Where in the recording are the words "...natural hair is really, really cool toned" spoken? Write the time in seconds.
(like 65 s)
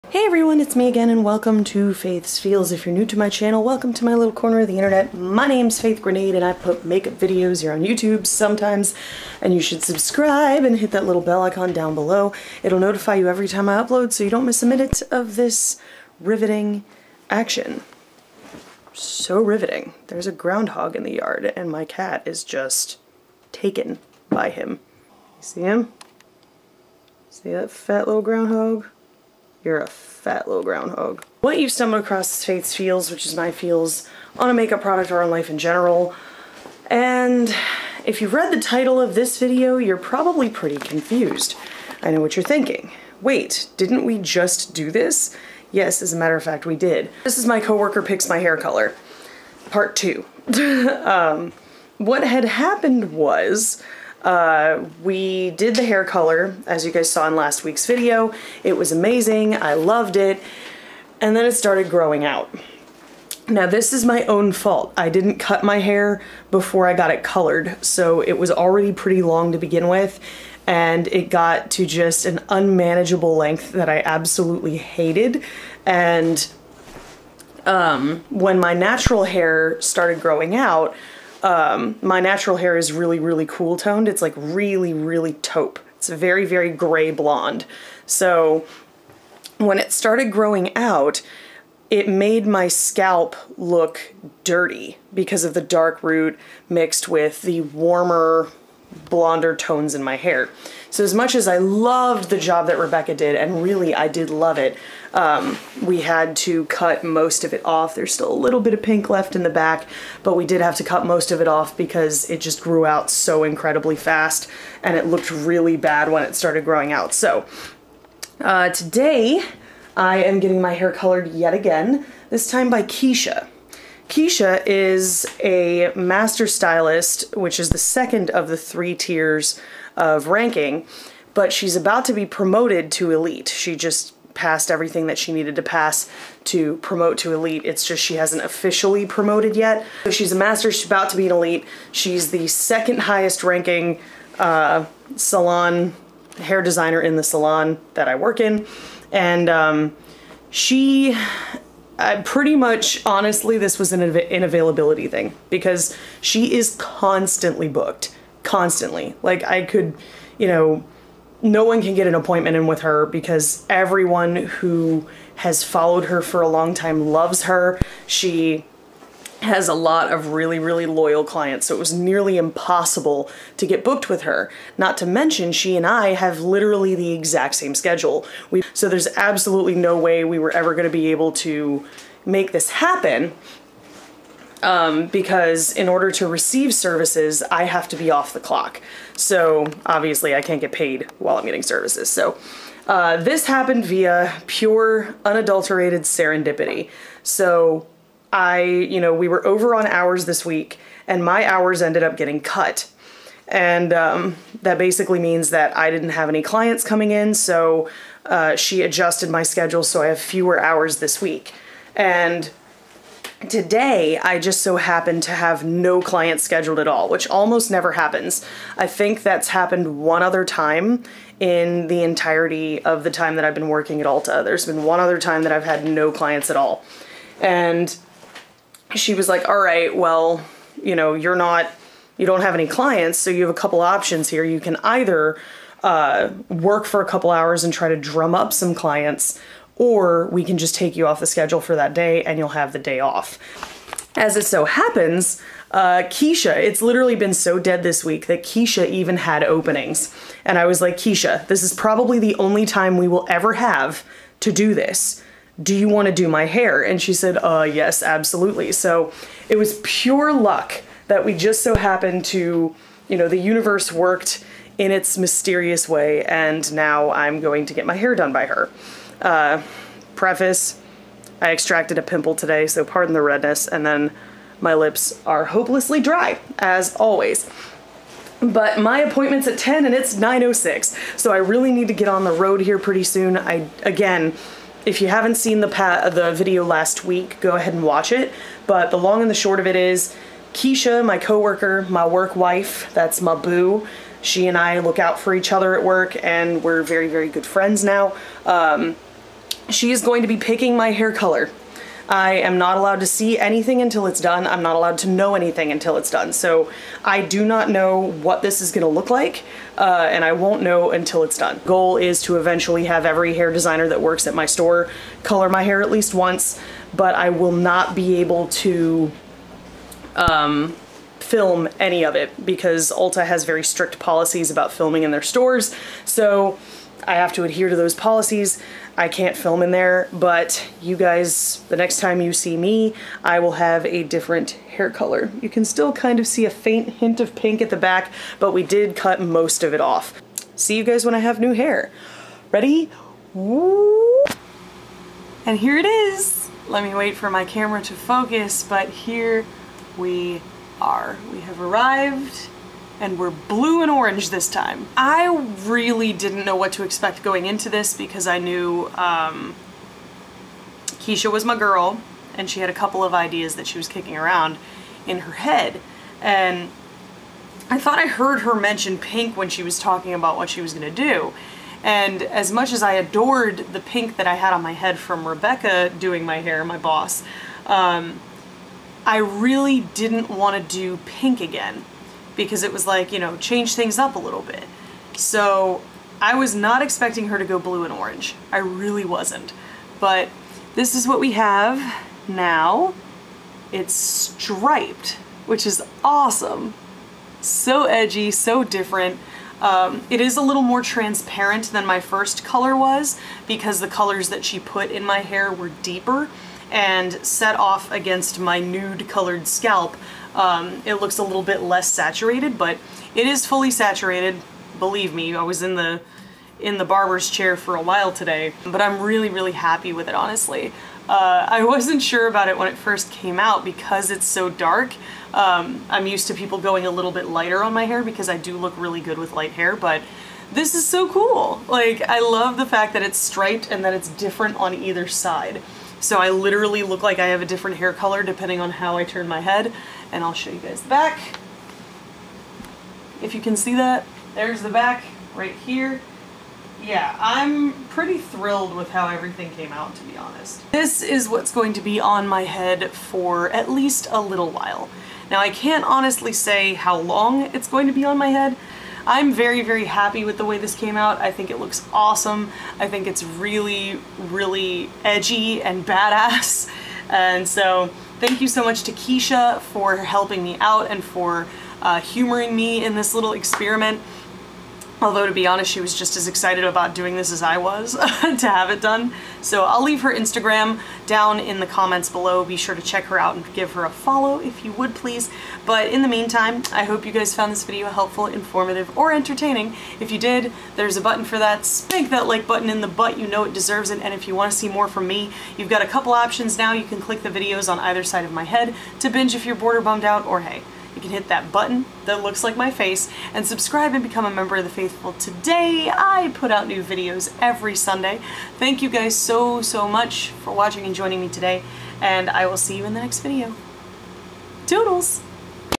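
82 s.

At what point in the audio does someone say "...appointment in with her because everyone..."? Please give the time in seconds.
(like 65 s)
162 s.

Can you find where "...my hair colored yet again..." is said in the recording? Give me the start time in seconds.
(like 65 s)
120 s.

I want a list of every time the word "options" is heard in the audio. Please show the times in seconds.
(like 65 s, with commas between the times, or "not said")
233 s, 496 s.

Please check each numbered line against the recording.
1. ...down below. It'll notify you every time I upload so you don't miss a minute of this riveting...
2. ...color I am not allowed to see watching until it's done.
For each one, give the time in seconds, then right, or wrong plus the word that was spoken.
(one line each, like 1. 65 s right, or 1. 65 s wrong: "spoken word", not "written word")
1. 11 s right
2. 301 s wrong: "anything", not "watching".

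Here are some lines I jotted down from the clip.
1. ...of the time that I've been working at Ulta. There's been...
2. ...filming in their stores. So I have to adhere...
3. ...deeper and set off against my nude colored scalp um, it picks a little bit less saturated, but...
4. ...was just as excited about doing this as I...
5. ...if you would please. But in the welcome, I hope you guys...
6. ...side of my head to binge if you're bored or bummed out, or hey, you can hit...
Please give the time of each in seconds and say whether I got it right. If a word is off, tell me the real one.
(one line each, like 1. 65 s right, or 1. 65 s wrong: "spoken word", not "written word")
1. 222 s right
2. 324 s right
3. 405 s wrong: "looks", not "picks"
4. 475 s right
5. 484 s wrong: "meantime", not "welcome"
6. 498 s right.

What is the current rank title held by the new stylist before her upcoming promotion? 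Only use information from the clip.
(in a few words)
Master stylist.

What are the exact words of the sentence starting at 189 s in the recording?
So obviously, I can't get paid while I'm getting services.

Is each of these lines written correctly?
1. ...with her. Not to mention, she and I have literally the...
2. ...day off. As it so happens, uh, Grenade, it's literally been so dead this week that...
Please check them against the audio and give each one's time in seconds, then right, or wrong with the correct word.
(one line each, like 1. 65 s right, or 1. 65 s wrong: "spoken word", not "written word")
1. 174 s right
2. 242 s wrong: "Keisha", not "Grenade".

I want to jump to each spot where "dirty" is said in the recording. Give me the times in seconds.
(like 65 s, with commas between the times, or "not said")
94 s.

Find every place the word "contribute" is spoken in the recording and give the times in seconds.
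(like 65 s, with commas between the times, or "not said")
not said.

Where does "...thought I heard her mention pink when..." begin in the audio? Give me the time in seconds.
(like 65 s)
367 s.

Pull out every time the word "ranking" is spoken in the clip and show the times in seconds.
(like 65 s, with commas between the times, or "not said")
130 s, 143 s.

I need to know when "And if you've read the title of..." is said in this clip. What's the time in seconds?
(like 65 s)
36 s.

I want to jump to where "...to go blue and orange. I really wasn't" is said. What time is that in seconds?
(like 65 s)
387 s.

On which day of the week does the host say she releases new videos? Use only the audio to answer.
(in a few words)
Sunday.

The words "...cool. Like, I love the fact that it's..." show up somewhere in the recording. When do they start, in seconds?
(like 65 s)
431 s.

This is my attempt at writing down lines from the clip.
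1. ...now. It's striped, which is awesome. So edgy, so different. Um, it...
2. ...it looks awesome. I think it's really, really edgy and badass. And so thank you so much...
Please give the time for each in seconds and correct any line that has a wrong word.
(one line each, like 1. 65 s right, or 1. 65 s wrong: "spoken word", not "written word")
1. 392 s right
2. 461 s right.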